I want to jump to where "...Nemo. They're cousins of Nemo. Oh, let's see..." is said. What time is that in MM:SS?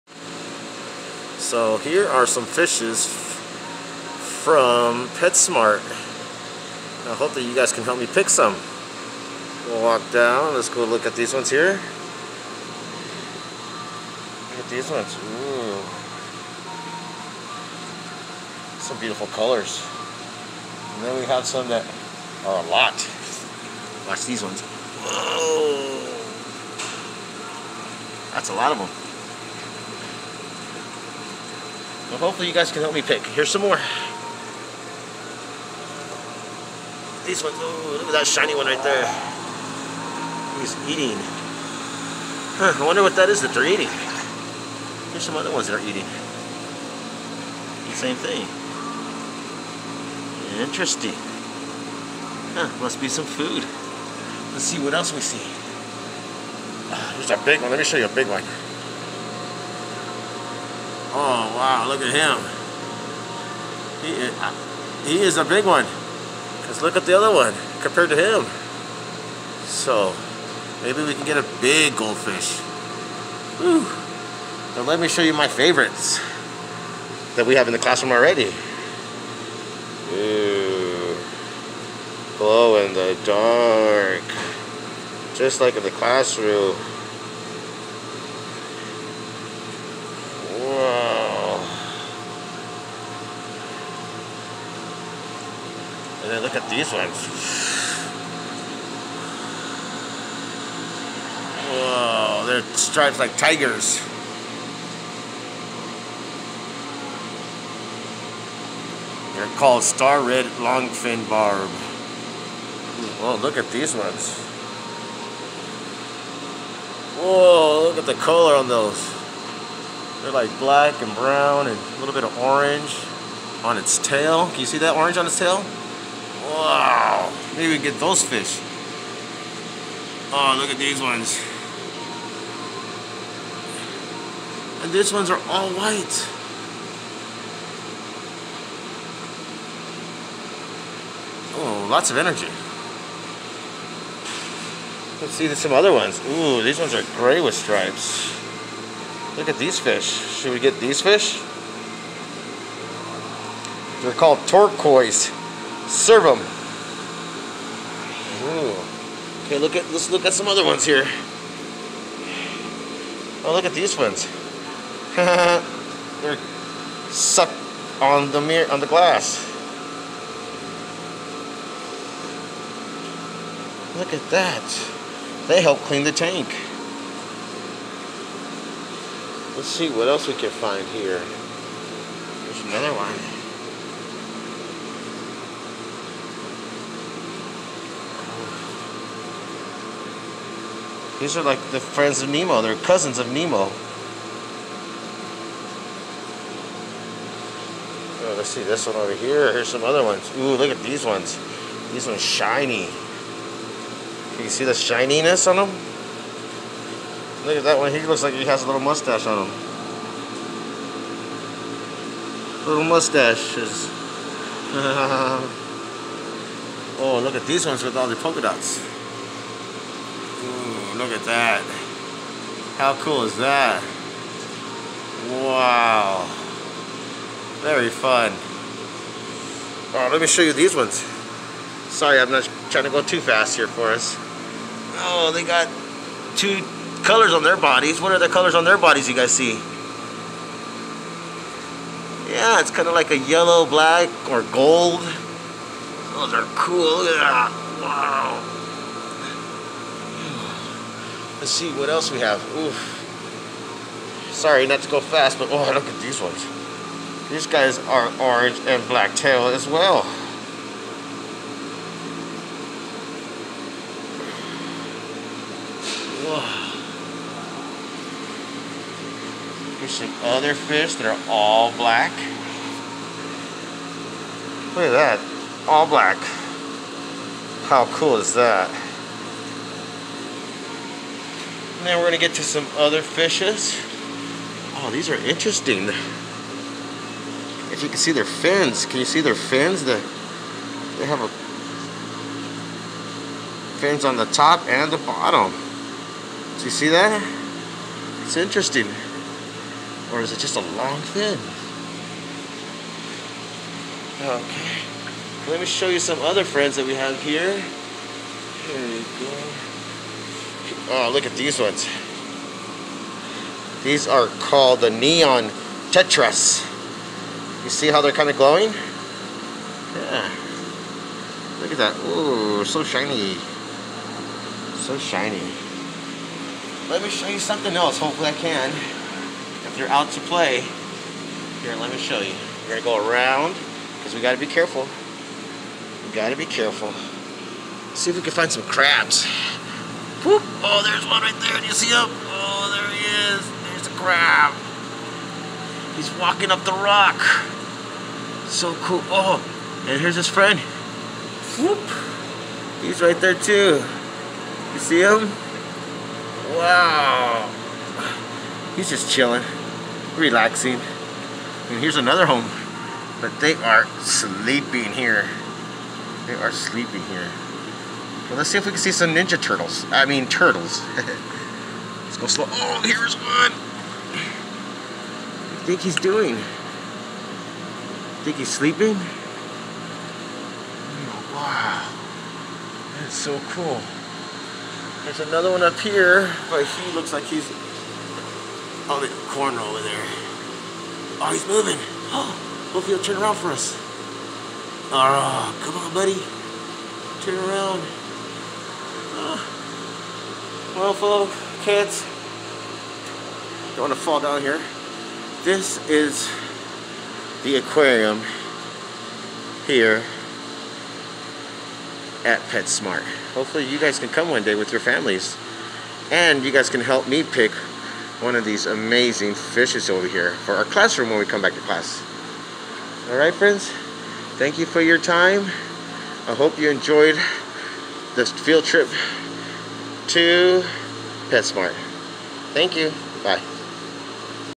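03:12.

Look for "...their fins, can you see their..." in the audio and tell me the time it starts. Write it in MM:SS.
04:48.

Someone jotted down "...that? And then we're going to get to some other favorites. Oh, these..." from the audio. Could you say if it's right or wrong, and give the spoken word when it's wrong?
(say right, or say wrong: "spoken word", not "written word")
wrong: "fishes", not "favorites".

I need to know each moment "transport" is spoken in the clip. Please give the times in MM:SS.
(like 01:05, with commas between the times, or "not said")
not said.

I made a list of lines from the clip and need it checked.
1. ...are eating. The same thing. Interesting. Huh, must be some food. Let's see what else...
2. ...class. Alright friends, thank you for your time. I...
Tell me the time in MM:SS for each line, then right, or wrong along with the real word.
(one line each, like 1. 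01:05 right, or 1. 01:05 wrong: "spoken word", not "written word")
1. 00:45 right
2. 07:01 right.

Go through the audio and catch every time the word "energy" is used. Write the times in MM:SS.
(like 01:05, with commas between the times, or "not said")
02:22.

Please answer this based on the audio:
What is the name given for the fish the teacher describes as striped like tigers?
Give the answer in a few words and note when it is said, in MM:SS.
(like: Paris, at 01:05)
Star red longfin barb, at 01:49.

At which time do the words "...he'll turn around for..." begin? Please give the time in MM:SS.
06:32.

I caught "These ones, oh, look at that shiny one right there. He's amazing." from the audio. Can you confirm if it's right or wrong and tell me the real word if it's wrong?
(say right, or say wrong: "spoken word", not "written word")
wrong: "eating", not "amazing".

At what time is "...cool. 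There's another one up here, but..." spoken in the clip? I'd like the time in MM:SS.
06:23.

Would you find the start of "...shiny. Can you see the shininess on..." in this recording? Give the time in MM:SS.
03:22.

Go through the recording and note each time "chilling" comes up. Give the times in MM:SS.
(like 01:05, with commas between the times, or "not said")
05:59.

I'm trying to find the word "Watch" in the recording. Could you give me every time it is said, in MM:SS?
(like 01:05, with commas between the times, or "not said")
00:24.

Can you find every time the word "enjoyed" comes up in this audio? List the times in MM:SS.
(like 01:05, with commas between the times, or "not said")
07:06.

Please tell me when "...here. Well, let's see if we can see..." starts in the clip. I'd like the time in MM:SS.
06:07.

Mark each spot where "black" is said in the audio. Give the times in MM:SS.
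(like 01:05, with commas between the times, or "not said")
02:00, 04:03, 04:18, 04:31, 04:35.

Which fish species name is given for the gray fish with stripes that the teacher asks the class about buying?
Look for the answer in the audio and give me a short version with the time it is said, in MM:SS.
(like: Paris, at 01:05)
Turquoise Severum, at 02:34.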